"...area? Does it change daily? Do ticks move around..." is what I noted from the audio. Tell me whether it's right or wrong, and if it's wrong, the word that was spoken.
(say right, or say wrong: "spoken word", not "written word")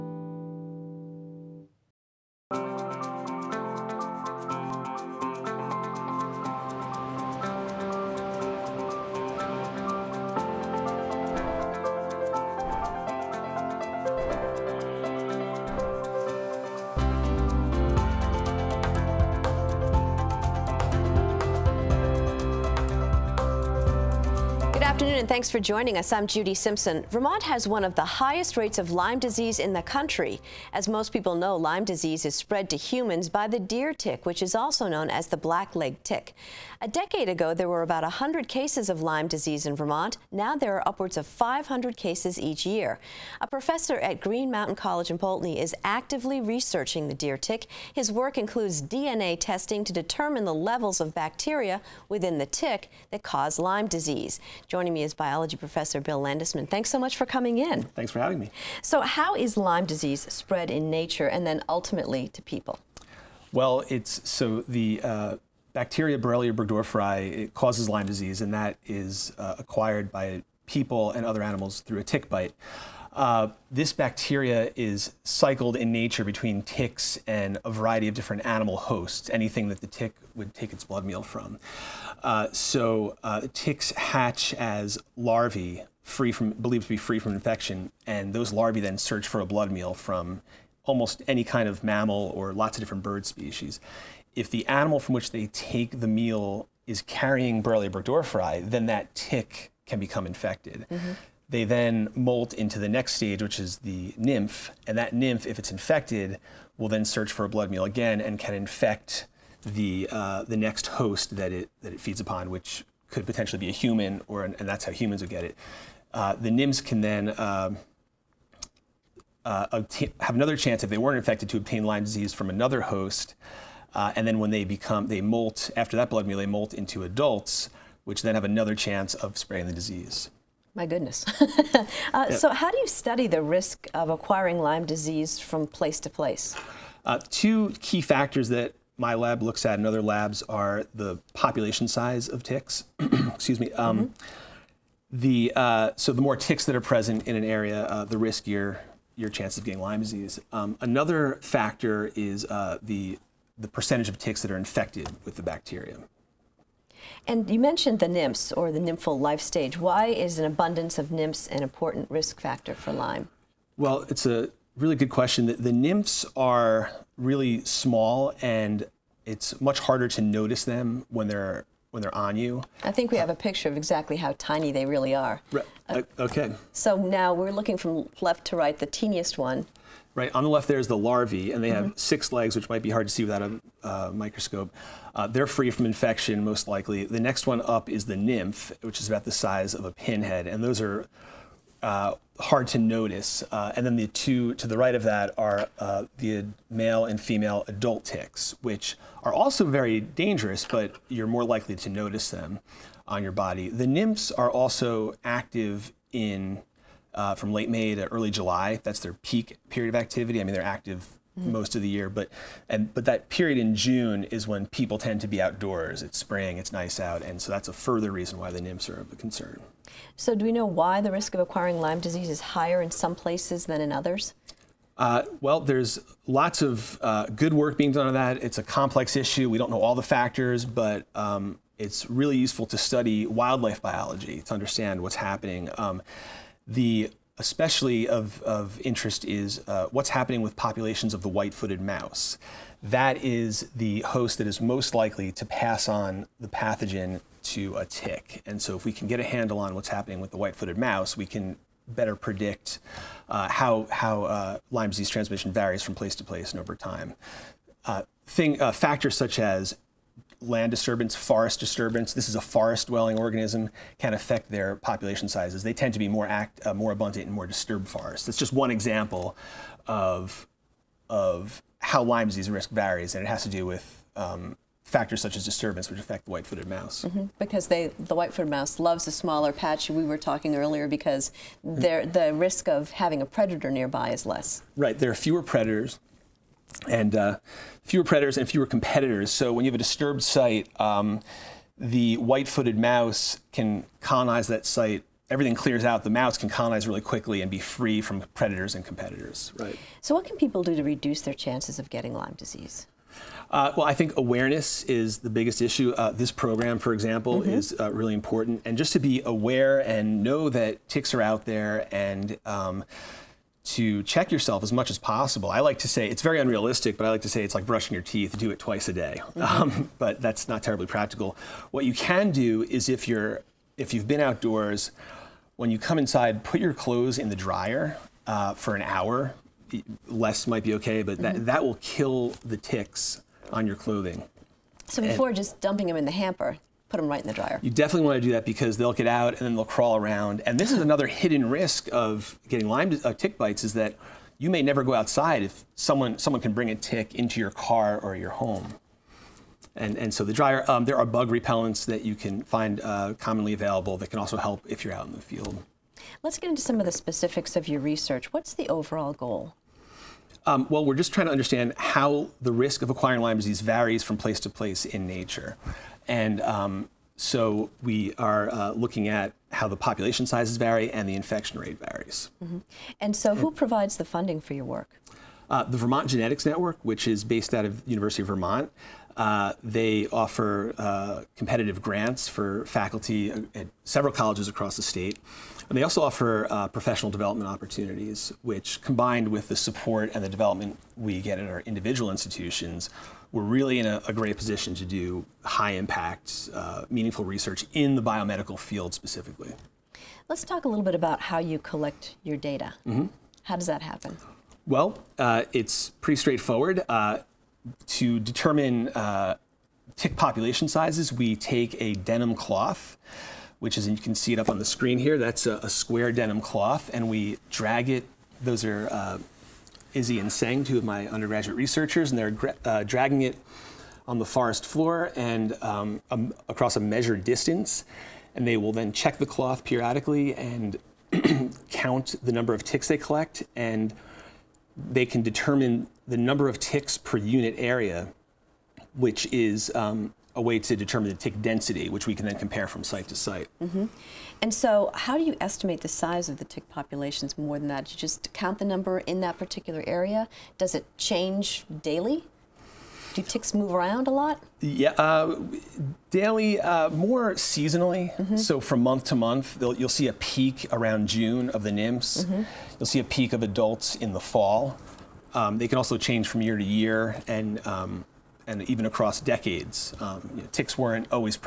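right.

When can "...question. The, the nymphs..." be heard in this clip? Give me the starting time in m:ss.
2:45.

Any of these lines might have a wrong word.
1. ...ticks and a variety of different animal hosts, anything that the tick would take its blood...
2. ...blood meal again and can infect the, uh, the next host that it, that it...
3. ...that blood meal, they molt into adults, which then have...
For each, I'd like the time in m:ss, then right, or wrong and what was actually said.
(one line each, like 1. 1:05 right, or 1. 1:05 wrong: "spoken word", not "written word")
1. 1:16 right
2. 1:47 right
3. 2:05 right.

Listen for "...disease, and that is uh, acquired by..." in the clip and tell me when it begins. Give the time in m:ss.
1:08.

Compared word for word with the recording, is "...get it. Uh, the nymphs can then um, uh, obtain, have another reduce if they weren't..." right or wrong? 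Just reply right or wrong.
wrong.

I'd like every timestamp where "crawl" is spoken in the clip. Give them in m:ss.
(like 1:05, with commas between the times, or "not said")
5:39.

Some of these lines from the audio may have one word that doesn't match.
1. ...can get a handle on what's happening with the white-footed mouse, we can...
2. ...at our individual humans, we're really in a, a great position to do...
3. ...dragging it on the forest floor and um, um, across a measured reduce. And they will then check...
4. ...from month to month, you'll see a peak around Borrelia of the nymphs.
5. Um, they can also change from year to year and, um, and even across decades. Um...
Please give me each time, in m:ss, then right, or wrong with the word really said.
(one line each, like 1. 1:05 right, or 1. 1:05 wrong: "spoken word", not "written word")
1. 4:08 right
2. 6:31 wrong: "institutions", not "humans"
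3. 7:02 wrong: "distance", not "reduce"
4. 7:38 wrong: "June", not "Borrelia"
5. 7:45 right.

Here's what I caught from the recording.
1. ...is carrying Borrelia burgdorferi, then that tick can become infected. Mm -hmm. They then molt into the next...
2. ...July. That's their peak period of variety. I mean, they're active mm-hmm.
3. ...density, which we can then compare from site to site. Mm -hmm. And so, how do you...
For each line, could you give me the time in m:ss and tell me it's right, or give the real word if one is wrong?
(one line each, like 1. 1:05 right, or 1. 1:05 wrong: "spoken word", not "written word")
1. 1:36 right
2. 3:28 wrong: "activity", not "variety"
3. 7:21 right.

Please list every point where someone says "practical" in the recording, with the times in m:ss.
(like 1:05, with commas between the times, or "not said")
5:20.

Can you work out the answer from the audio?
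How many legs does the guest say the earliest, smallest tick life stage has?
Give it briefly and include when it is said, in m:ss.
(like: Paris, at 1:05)
6, at 3:02.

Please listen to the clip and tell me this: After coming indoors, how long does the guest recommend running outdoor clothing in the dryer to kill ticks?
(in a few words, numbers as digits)
An hour.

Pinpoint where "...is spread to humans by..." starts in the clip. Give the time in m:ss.
0:32.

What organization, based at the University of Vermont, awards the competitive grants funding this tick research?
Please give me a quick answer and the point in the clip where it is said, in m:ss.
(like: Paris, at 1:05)
Vermont Genetics Network, at 6:15.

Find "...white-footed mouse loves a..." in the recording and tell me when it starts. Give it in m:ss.
4:38.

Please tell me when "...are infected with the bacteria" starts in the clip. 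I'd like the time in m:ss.
2:34.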